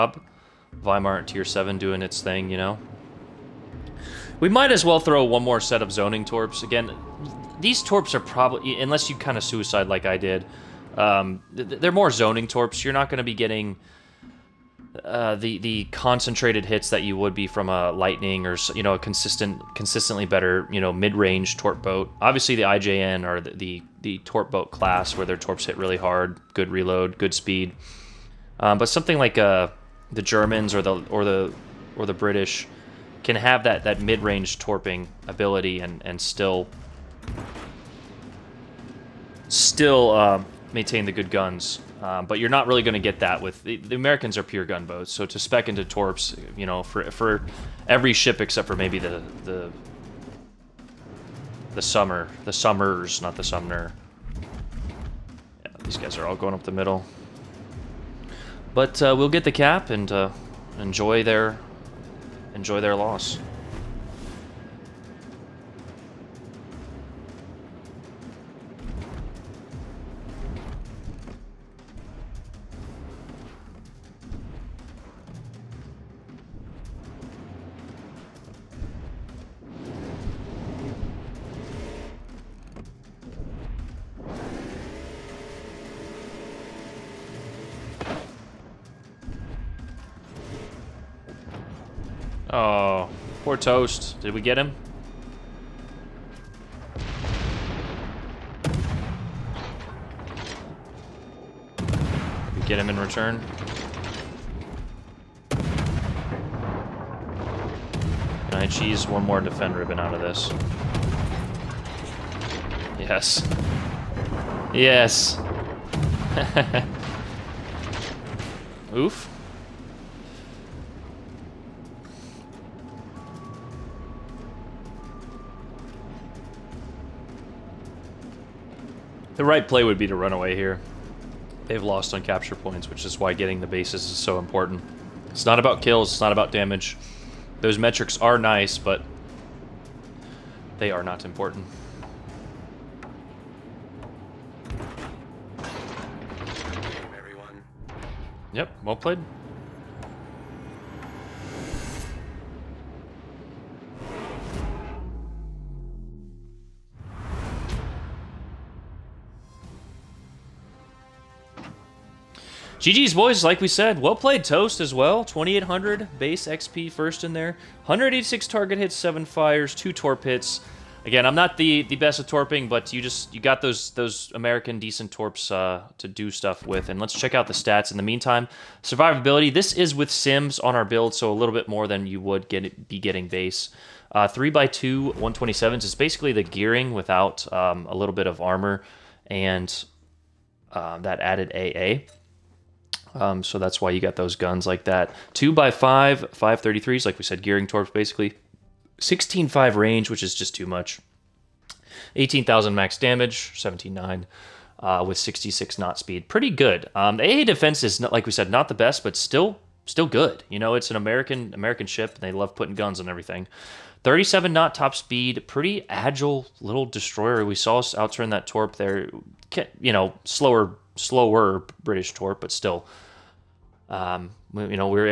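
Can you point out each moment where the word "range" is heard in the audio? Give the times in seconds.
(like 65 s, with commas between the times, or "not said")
21 s, 34 s, 199 s.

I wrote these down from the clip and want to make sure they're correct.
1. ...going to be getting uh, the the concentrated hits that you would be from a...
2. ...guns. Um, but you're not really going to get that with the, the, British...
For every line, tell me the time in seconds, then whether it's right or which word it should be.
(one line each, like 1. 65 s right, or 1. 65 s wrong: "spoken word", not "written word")
1. 13 s right
2. 41 s wrong: "Americans", not "British".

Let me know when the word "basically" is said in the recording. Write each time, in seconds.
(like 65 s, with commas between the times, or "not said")
185 s, 197 s.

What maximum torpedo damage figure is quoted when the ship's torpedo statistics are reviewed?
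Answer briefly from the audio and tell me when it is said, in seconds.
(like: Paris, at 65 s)
18,000, at 202 s.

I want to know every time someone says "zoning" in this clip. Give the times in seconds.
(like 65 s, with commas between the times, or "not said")
5 s, 12 s.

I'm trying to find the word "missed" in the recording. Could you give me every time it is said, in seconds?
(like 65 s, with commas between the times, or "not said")
not said.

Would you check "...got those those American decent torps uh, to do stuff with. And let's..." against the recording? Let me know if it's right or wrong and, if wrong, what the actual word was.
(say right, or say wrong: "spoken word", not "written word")
right.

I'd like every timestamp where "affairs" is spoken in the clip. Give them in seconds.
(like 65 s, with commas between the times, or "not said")
not said.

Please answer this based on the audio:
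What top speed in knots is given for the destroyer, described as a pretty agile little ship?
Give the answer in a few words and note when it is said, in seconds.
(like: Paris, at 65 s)
37 knots, at 214 s.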